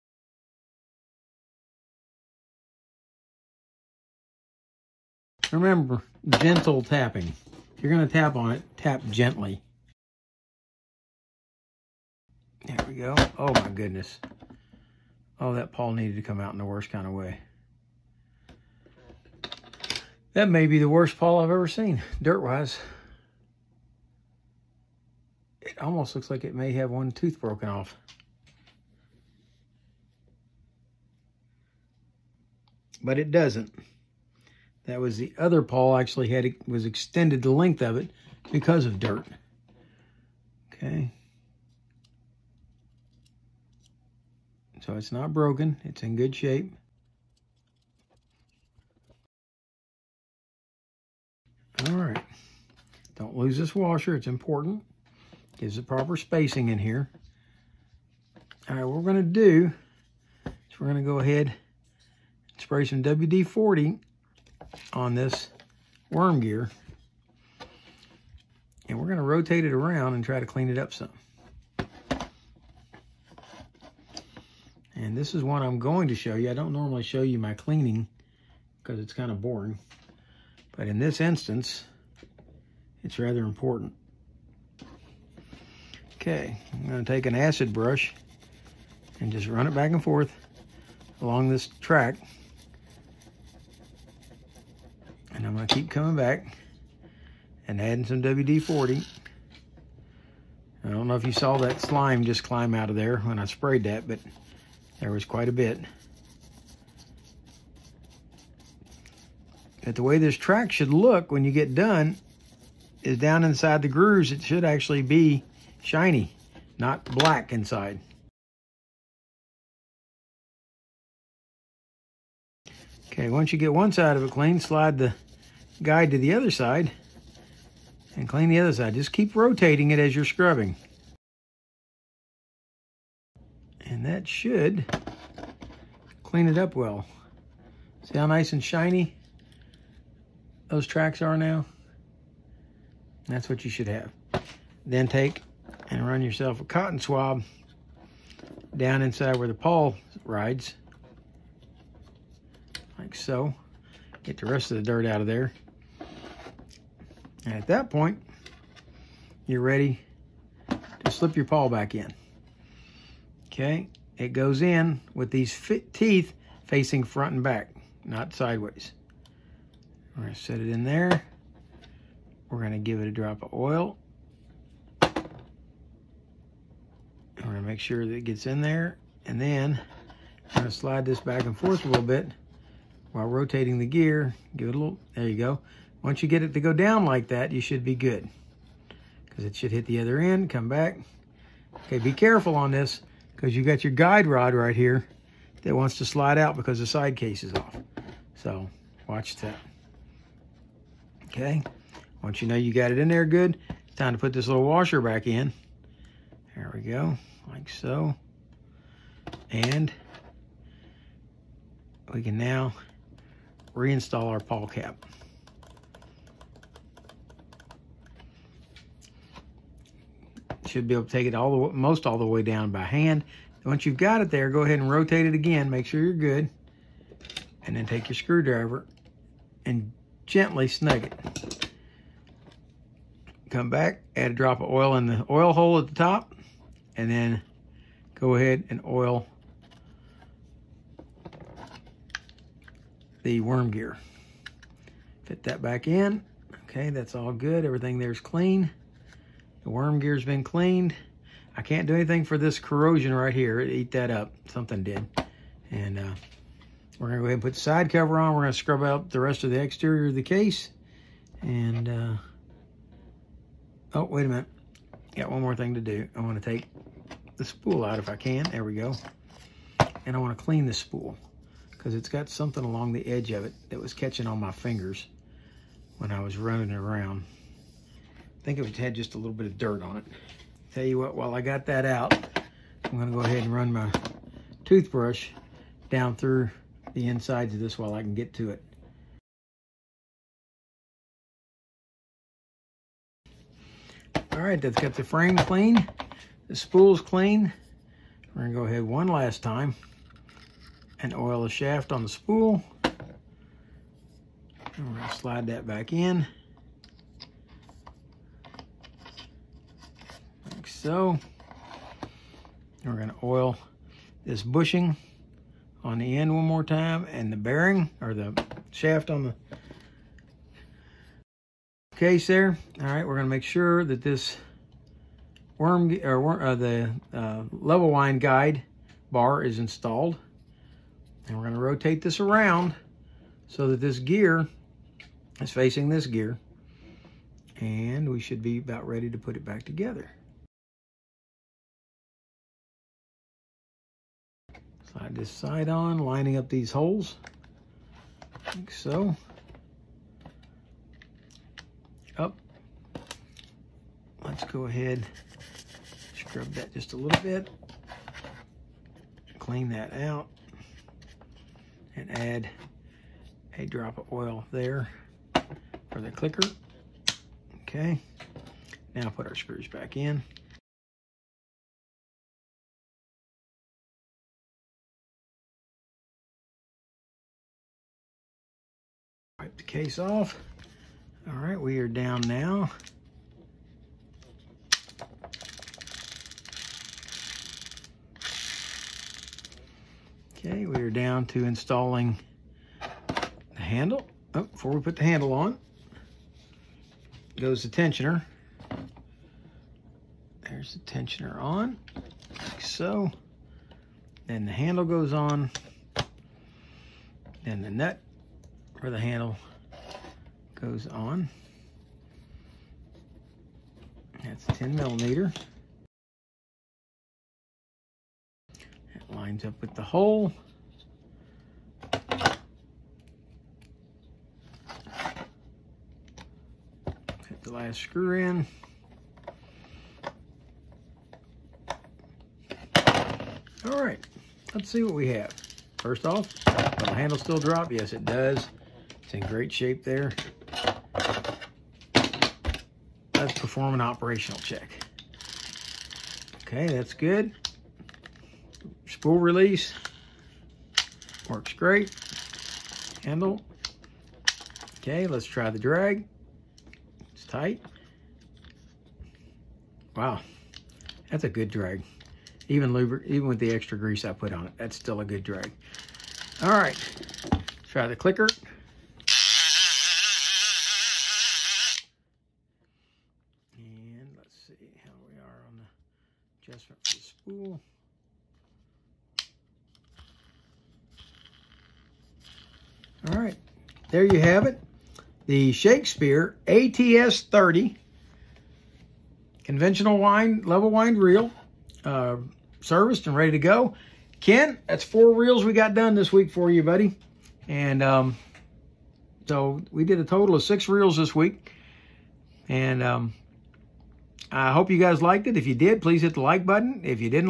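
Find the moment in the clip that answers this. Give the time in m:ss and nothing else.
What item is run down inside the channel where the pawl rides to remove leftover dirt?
2:26.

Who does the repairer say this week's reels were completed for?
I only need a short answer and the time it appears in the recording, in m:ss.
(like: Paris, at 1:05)
Ken, at 8:14.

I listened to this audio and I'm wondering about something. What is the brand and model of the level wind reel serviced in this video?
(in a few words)
Shakespeare ATS 30.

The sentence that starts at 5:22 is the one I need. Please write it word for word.
All right, we're gonna make sure that this worm or uh, the uh, level wind guide bar is installed.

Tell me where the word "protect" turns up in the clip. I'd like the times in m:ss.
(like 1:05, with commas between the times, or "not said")
not said.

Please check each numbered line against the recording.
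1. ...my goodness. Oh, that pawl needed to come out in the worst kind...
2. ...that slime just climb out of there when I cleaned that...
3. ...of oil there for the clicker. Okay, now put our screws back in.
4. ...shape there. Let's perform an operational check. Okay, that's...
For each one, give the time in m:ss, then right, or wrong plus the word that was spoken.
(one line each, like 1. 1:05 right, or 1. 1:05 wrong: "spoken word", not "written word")
1. 0:13 right
2. 1:41 wrong: "sprayed", not "cleaned"
3. 6:03 right
4. 7:19 right.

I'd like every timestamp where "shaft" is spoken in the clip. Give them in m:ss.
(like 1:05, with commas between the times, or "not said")
5:01, 5:18.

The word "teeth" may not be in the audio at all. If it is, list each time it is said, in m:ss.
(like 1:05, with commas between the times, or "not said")
2:45.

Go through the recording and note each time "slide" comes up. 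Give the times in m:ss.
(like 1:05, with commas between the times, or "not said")
2:04, 3:00, 3:16, 5:05, 5:44.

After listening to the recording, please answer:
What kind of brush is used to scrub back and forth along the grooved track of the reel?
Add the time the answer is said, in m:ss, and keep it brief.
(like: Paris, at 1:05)
acid brush, at 1:27.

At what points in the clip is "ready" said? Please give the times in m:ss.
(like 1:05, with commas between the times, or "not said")
2:39, 5:38, 8:13.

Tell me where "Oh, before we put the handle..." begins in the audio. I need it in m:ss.
6:34.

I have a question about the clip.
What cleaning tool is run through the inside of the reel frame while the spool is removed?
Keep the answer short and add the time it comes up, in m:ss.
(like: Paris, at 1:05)
toothbrush, at 4:44.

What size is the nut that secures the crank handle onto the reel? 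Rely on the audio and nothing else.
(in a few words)
10 millimeter.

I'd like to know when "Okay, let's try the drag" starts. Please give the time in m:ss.
7:34.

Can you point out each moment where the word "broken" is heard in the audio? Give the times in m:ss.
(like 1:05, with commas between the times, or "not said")
0:27, 0:45.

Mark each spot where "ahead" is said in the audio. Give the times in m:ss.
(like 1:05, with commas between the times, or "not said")
1:01, 3:44, 3:58, 4:17, 4:43, 4:58, 5:54.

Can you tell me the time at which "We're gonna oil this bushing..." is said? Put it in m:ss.
5:12.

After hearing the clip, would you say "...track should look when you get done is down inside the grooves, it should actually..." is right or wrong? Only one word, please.
right.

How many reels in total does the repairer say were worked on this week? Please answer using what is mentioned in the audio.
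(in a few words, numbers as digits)
6.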